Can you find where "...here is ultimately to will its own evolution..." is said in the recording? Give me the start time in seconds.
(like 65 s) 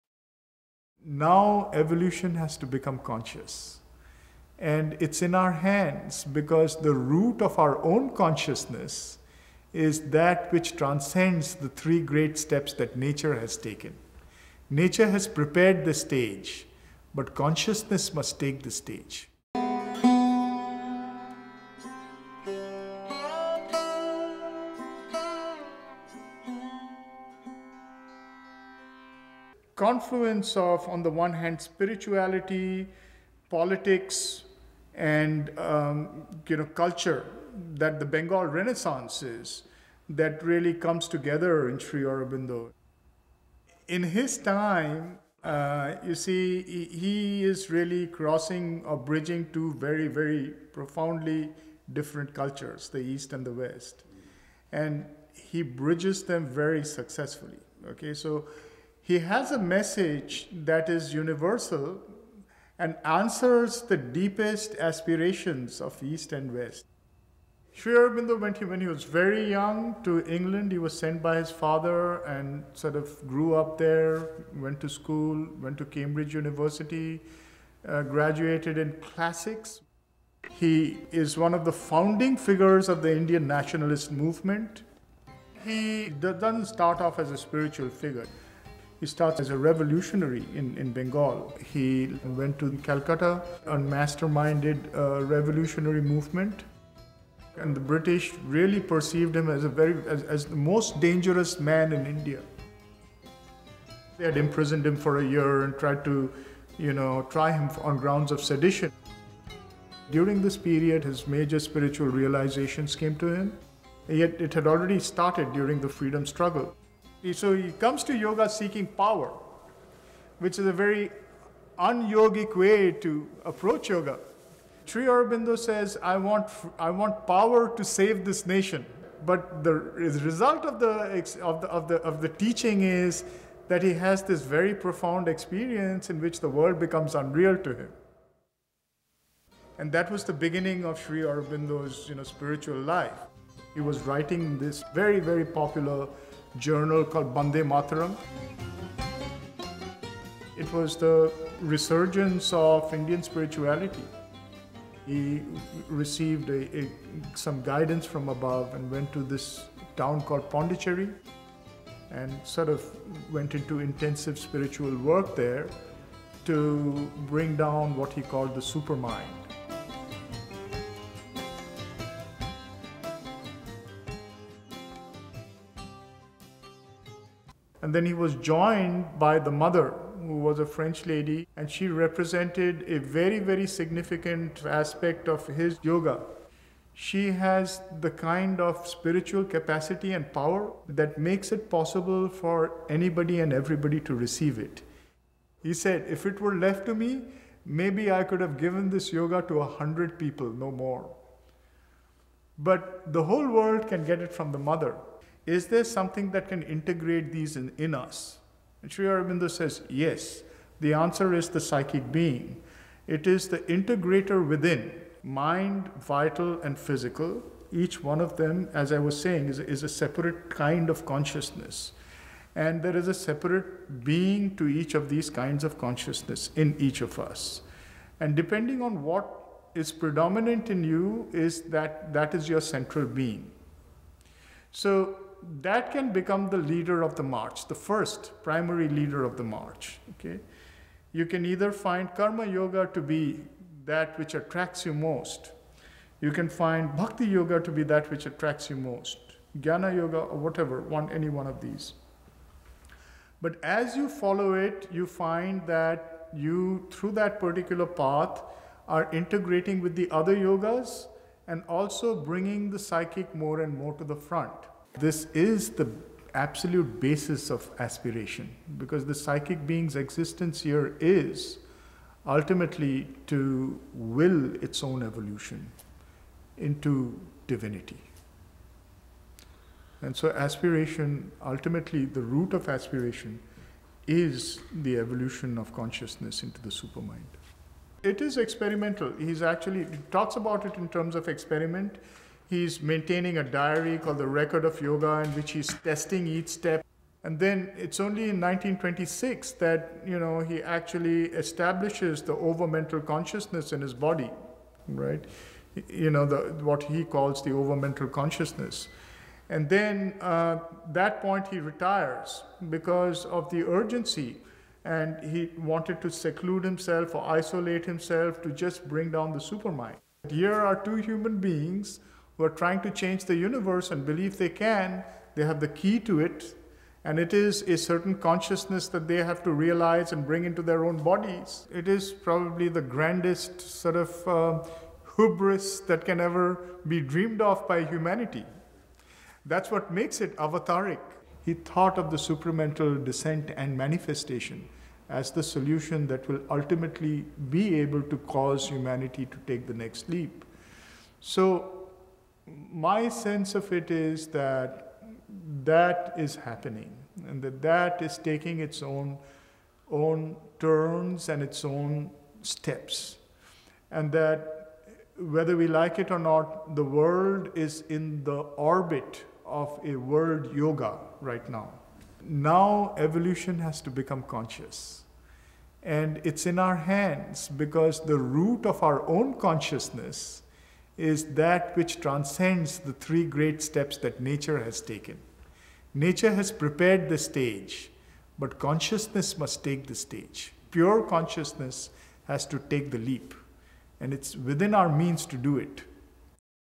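270 s.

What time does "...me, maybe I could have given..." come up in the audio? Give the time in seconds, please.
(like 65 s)
196 s.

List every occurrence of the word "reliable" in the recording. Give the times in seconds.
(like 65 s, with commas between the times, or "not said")
not said.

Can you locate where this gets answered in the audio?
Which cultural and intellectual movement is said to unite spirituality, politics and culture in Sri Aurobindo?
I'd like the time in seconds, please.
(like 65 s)
38 s.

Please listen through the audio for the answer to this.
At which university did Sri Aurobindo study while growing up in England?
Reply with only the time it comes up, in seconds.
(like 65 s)
75 s.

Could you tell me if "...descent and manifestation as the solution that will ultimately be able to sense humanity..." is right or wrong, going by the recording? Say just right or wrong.
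wrong.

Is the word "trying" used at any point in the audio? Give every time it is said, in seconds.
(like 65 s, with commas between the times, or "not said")
322 s.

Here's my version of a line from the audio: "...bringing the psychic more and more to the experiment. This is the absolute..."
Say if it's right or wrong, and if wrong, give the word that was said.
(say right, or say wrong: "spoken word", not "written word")
wrong: "front", not "experiment".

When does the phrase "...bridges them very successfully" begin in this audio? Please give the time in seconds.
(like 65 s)
55 s.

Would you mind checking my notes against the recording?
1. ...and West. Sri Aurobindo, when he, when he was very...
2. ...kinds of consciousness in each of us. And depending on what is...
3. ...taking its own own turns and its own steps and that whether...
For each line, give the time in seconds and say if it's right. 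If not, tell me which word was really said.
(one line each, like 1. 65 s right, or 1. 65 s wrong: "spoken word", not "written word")
1. 66 s right
2. 225 s right
3. 358 s right.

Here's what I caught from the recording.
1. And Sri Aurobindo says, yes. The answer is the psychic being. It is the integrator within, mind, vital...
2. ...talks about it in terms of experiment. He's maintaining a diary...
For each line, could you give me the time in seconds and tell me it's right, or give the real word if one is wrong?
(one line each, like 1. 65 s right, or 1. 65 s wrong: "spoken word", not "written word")
1. 208 s right
2. 290 s right.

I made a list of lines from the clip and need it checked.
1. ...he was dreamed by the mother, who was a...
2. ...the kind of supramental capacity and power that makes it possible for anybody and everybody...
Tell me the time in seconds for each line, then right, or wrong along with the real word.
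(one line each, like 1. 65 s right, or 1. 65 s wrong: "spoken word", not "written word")
1. 178 s wrong: "joined", not "dreamed"
2. 188 s wrong: "spiritual", not "supramental".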